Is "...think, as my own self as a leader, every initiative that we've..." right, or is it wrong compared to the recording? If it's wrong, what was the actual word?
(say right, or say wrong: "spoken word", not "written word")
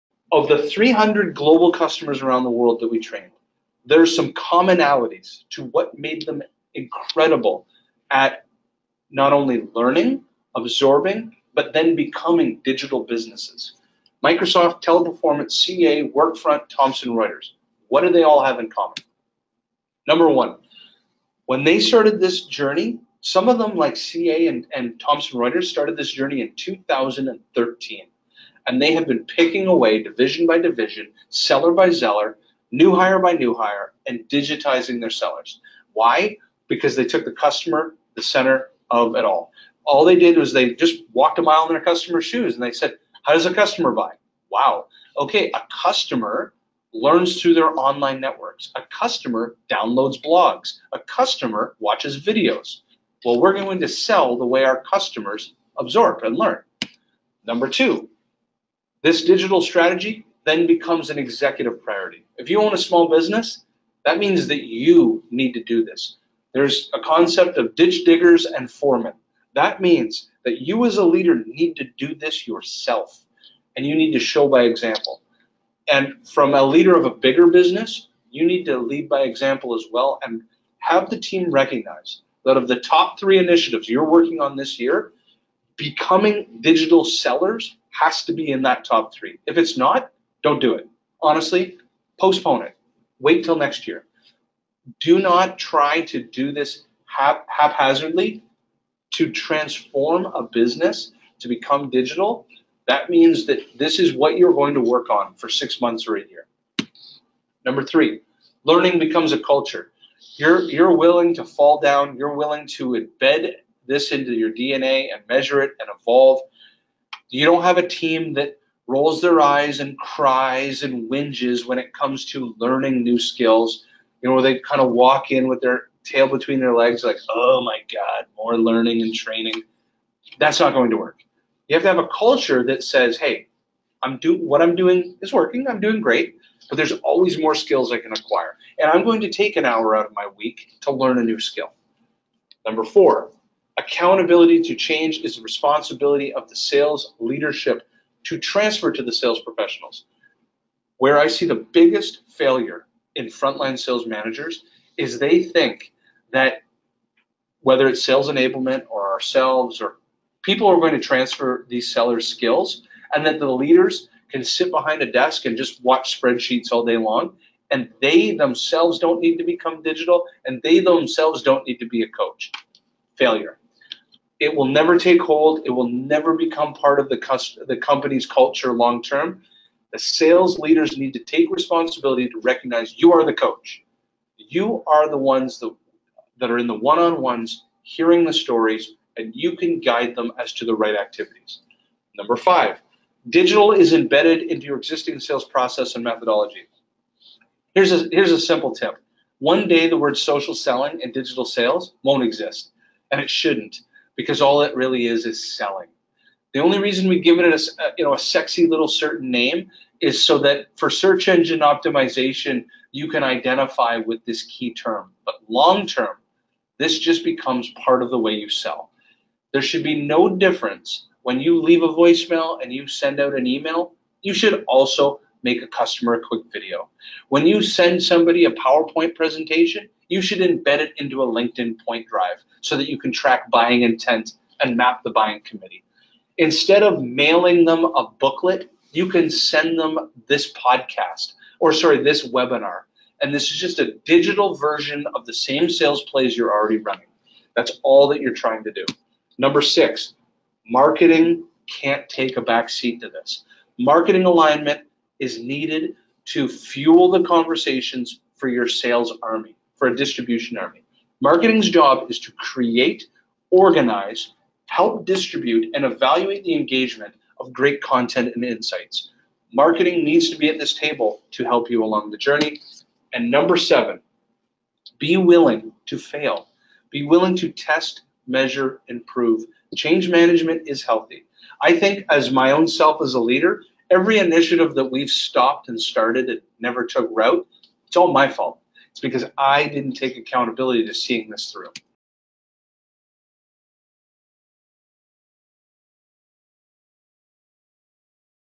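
right.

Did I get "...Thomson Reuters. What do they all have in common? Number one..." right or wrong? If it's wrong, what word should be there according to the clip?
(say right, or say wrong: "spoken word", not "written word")
right.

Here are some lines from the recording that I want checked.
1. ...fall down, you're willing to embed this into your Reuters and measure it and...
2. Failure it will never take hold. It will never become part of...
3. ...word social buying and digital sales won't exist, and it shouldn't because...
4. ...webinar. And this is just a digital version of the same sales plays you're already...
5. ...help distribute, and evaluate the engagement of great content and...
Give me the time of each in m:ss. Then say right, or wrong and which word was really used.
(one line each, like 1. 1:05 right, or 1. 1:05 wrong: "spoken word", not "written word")
1. 1:51 wrong: "DNA", not "Reuters"
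2. 2:53 right
3. 3:19 wrong: "selling", not "buying"
4. 4:02 right
5. 4:24 right.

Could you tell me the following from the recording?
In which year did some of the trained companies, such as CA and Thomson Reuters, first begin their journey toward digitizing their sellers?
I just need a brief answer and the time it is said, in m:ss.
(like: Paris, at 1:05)
2013, at 0:26.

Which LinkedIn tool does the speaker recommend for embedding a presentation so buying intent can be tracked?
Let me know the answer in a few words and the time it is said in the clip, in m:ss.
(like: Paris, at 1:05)
LinkedIn PointDrive, at 3:51.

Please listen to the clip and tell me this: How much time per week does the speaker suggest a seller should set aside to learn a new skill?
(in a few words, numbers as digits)
An hour.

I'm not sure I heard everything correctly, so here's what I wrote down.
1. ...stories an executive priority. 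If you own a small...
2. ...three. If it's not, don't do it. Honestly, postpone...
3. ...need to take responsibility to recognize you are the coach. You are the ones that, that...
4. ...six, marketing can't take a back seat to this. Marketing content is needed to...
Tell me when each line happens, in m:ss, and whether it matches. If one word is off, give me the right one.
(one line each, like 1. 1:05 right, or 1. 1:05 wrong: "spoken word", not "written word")
1. 1:00 wrong: "becomes", not "stories"
2. 1:29 right
3. 3:00 right
4. 4:09 wrong: "alignment", not "content".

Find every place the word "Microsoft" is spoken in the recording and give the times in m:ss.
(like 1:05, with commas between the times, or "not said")
0:14.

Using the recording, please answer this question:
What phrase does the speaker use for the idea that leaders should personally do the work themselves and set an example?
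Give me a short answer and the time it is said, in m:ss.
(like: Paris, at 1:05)
Ditch diggers and foremen, at 1:07.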